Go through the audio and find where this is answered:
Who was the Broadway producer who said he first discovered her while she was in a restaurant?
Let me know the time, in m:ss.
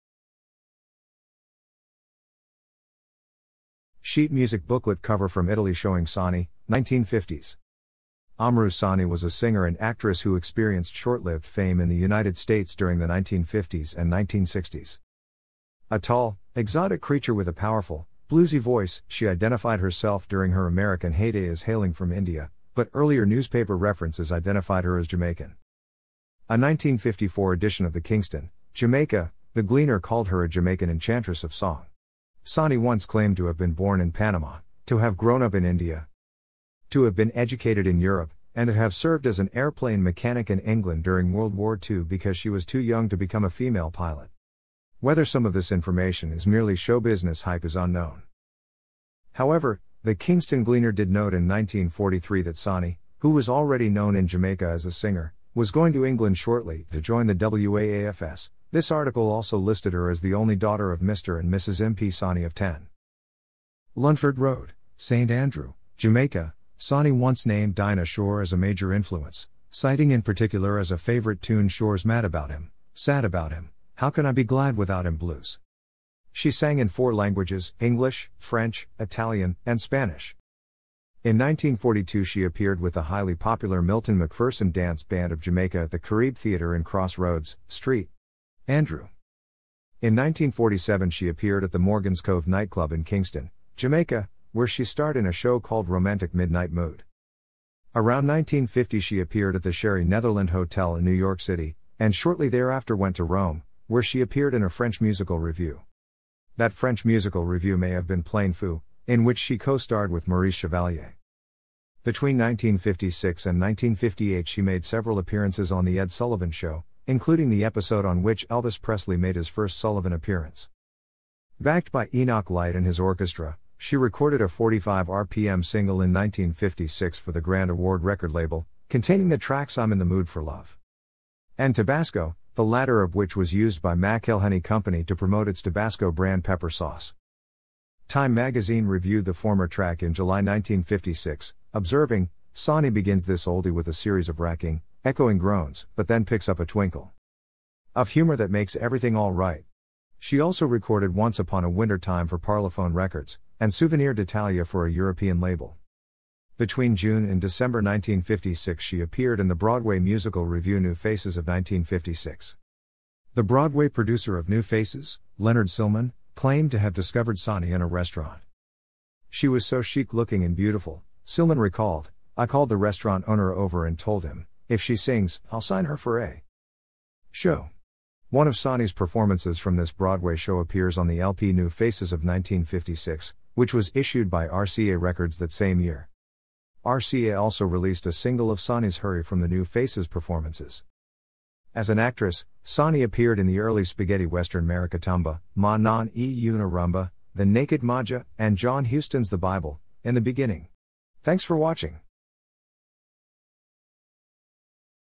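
2:45.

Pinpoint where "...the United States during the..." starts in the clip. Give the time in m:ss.
0:11.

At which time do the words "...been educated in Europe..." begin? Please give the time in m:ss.
0:37.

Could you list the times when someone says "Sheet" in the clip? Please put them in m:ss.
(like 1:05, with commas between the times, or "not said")
0:04.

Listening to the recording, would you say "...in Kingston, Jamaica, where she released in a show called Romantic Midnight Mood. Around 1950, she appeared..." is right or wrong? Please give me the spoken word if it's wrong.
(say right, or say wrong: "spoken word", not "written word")
wrong: "starred", not "released".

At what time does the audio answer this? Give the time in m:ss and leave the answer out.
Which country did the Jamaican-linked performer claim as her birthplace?
0:34.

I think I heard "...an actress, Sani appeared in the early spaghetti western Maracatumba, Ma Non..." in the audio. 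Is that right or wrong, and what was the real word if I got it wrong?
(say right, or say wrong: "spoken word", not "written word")
right.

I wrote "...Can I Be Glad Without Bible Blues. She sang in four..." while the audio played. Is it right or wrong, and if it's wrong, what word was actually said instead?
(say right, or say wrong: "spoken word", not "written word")
wrong: "Him", not "Bible".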